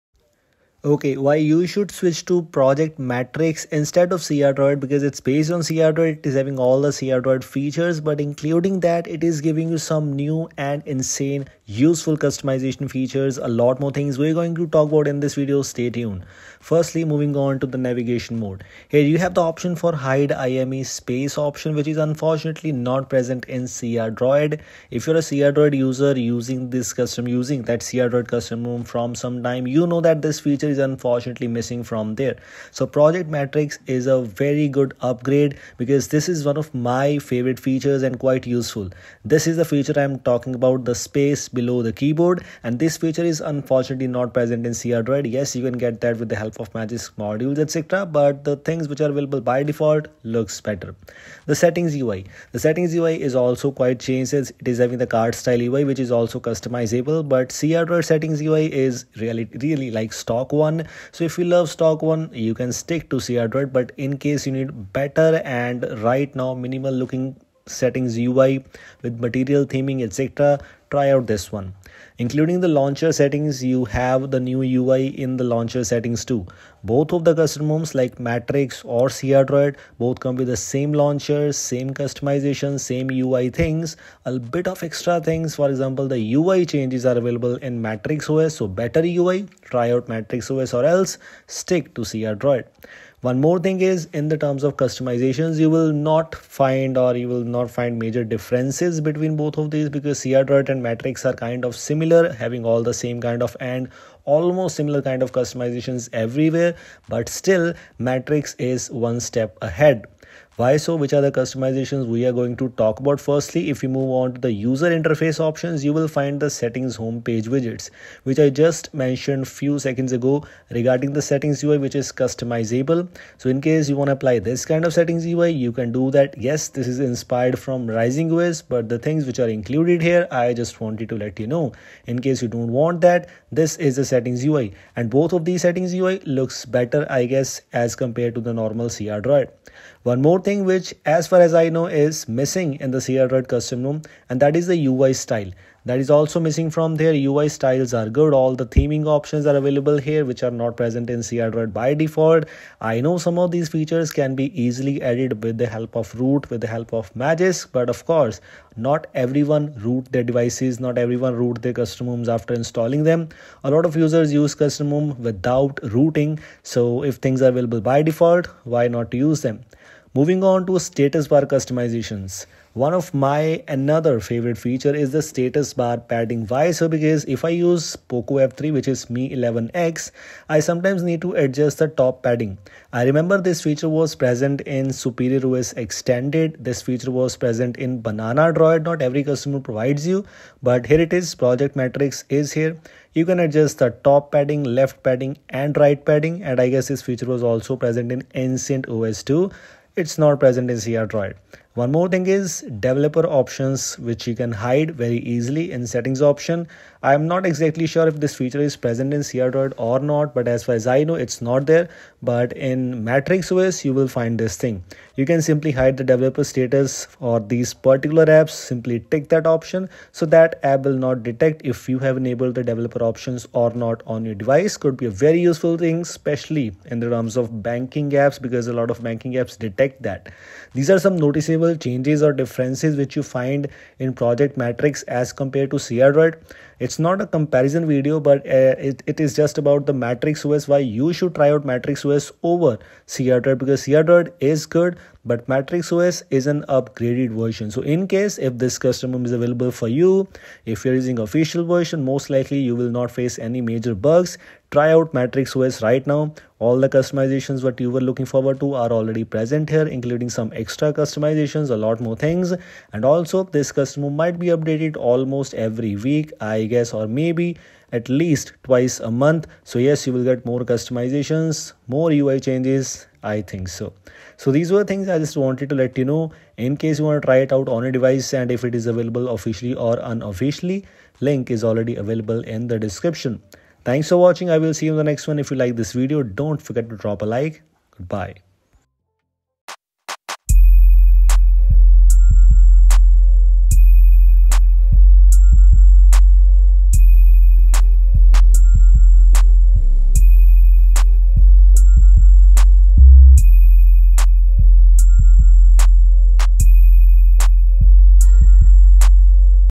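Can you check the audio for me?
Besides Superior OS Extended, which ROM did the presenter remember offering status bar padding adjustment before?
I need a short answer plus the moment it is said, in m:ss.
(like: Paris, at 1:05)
Banana Droid, at 3:08.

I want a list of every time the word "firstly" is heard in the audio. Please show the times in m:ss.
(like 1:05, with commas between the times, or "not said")
0:16, 1:53.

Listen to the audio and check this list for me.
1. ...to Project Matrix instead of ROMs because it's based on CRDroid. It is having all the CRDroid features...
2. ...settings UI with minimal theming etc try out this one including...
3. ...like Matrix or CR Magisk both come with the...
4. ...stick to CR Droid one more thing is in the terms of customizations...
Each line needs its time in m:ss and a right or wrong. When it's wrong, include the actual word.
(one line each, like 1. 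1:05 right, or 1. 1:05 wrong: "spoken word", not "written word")
1. 0:02 wrong: "CRDroid", not "ROMs"
2. 1:07 wrong: "material", not "minimal"
3. 1:17 wrong: "Droid", not "Magisk"
4. 1:31 right.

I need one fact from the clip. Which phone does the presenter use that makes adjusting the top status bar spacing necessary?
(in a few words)
Poco F3.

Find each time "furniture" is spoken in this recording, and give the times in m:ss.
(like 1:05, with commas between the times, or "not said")
not said.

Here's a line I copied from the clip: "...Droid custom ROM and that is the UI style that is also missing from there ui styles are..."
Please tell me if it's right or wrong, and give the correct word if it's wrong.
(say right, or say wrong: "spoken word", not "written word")
right.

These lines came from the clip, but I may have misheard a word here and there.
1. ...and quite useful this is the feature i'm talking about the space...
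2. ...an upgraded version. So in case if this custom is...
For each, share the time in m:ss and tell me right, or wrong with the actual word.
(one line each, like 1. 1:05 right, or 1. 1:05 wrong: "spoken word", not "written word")
1. 0:38 right
2. 4:06 right.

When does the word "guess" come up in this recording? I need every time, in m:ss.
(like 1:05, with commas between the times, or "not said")
2:17, 3:16, 4:26.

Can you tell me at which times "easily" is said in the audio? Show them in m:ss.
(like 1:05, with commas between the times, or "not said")
2:34, 3:25.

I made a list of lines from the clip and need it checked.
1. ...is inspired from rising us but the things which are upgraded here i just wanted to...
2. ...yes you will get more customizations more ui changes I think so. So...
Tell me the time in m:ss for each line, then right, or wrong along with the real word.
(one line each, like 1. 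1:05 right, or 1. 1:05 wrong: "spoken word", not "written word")
1. 2:06 wrong: "included", not "upgraded"
2. 4:29 right.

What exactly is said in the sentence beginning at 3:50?
These are some noticeable changes or differences which you find in Project Matrix as compared to CRDroid.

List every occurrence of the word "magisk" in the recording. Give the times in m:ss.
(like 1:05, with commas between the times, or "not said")
0:46, 2:37.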